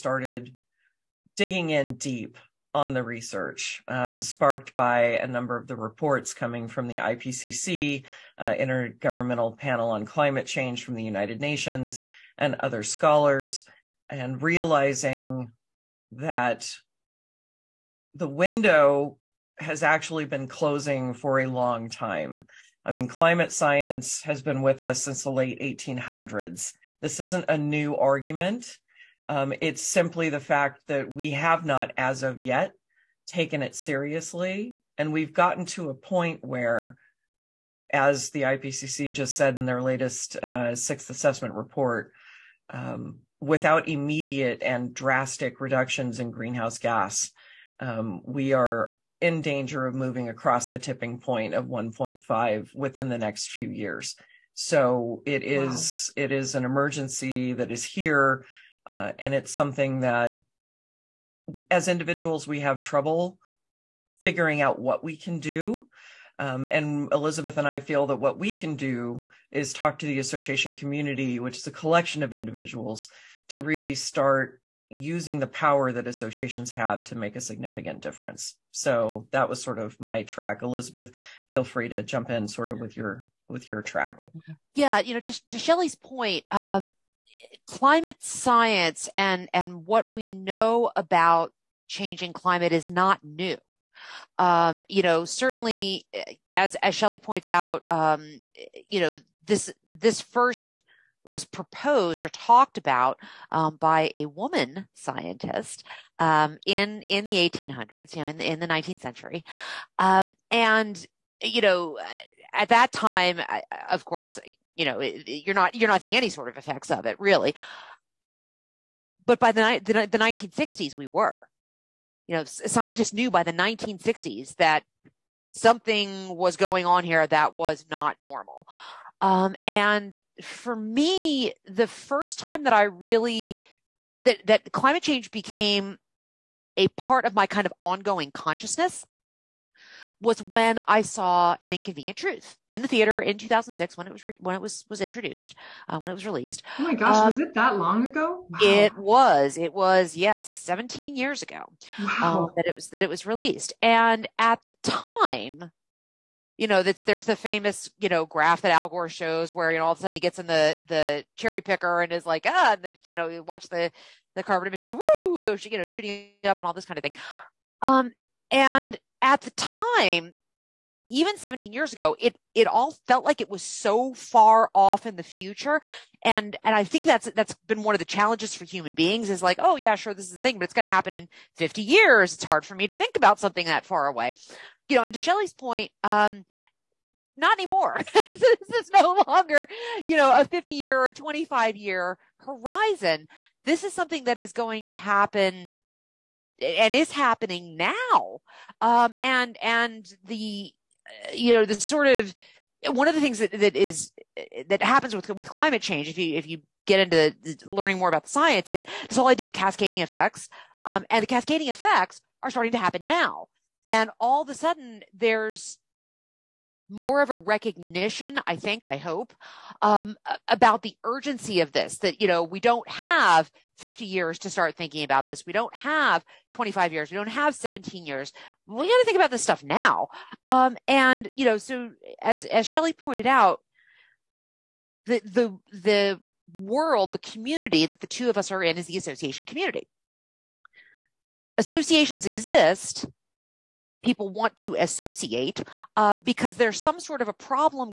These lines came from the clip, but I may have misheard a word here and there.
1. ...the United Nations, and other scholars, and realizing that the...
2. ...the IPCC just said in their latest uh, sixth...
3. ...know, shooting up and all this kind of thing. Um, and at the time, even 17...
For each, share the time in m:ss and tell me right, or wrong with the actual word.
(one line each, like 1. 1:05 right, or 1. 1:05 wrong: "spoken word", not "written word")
1. 0:10 right
2. 0:38 right
3. 2:45 right.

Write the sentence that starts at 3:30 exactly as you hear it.
Um, and the cascading effects are starting to happen now.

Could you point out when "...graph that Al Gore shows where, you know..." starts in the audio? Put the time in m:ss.
2:38.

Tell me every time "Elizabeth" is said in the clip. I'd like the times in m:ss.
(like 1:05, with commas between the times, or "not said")
1:07, 1:20.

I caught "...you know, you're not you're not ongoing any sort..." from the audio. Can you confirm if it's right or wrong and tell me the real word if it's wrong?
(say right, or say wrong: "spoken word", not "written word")
wrong: "seeing", not "ongoing".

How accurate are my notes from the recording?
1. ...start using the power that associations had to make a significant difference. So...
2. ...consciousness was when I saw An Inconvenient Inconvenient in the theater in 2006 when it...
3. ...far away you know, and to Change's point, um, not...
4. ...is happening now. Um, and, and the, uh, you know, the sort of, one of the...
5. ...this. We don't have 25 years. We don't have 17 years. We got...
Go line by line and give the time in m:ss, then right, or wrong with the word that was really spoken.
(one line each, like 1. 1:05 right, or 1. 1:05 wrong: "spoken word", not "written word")
1. 1:13 right
2. 2:18 wrong: "Truth", not "Inconvenient"
3. 3:03 wrong: "Shelly", not "Change"
4. 3:16 right
5. 3:45 right.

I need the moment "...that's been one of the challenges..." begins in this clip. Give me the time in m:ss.
2:57.